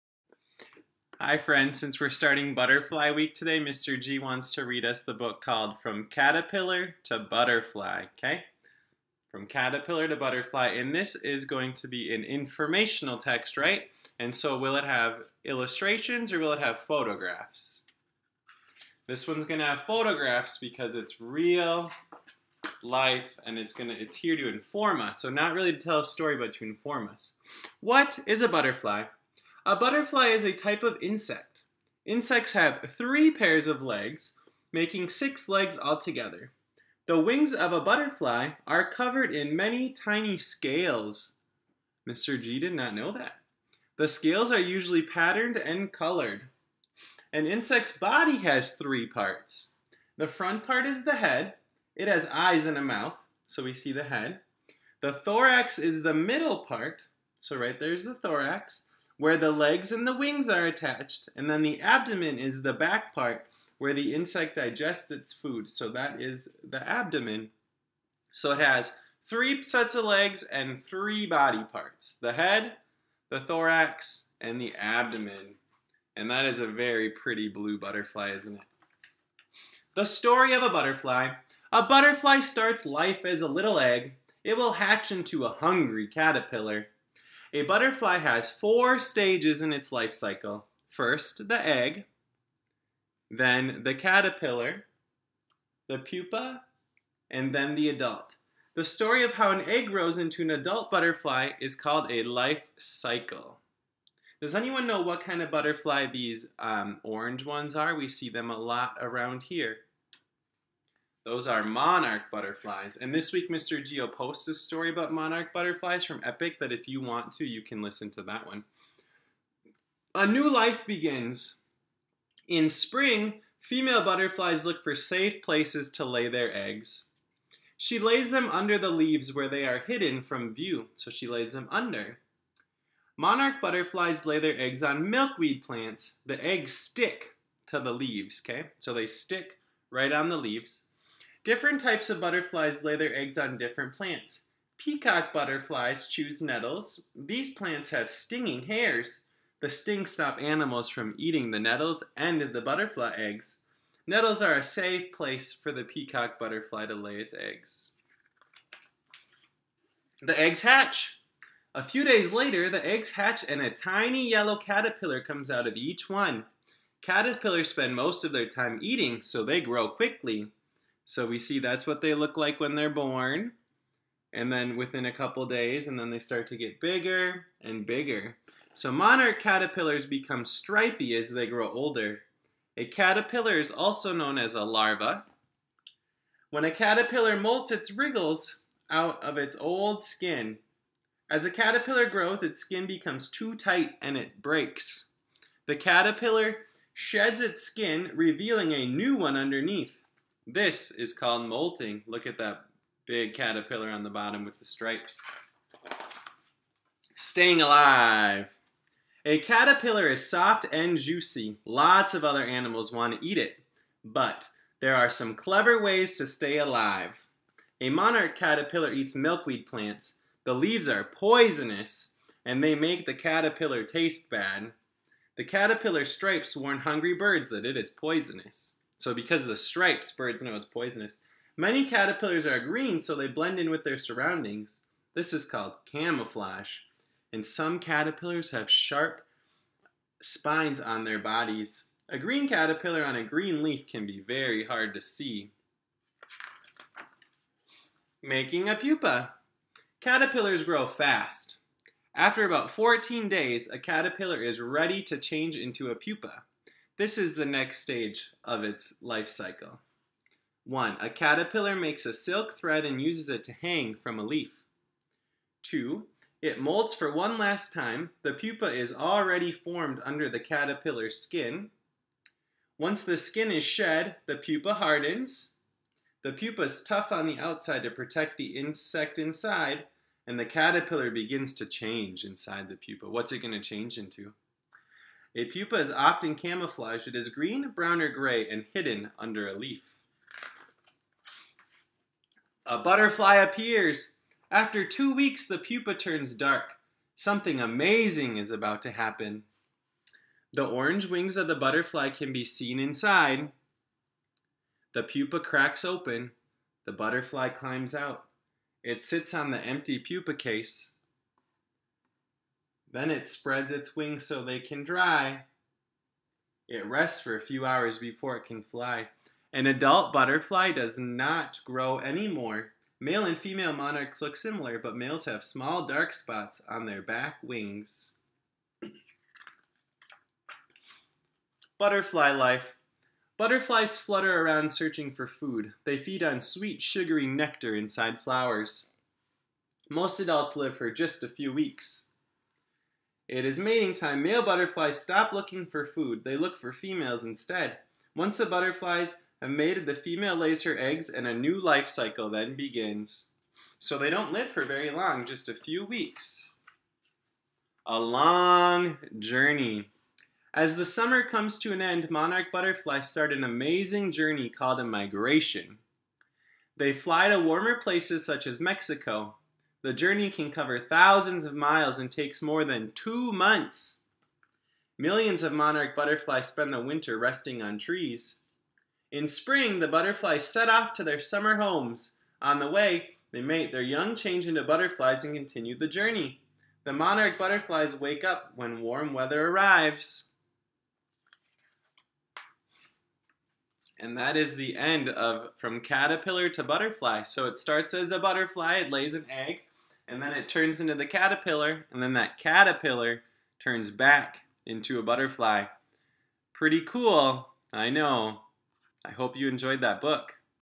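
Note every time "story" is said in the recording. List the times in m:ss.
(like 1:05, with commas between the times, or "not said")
0:26, 1:20, 1:38, 1:54.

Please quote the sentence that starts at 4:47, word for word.
It is green, brown, or gray and hidden under a leaf.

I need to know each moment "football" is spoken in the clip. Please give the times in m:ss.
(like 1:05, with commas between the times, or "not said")
not said.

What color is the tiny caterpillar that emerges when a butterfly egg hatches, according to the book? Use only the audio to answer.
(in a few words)
Yellow.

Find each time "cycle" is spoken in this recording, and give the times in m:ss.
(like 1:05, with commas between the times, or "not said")
1:30, 1:42, 4:19, 5:51.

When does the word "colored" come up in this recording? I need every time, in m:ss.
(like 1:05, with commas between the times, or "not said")
0:45.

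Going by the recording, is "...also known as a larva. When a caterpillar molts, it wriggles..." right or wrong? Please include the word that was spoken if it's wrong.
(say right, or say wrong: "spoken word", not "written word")
right.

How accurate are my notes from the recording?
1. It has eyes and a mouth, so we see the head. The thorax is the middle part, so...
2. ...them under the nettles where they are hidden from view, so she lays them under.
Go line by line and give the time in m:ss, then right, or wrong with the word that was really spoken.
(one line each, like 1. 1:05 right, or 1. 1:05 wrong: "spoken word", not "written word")
1. 0:51 right
2. 2:08 wrong: "leaves", not "nettles".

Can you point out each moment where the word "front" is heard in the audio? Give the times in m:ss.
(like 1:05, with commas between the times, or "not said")
0:50.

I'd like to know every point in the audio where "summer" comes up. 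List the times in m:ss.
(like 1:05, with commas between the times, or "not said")
6:00, 6:21.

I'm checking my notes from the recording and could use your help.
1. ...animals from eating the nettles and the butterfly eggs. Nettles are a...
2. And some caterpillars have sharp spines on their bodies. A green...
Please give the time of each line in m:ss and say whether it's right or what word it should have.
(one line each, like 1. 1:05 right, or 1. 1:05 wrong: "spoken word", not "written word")
1. 2:30 right
2. 3:57 right.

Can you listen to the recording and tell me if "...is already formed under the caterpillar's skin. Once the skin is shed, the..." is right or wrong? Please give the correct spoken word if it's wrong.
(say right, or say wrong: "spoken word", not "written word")
right.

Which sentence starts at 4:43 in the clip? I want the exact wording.
What's it going to change into?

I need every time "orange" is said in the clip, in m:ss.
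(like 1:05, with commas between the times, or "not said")
1:47, 5:00.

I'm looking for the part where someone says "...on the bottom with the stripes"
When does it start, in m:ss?
3:23.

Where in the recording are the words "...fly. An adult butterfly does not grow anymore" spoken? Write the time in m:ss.
5:18.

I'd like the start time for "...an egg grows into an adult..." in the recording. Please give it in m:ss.
1:39.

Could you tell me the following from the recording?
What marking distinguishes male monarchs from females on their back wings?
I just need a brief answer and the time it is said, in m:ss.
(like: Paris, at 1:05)
Small dark spots, at 5:25.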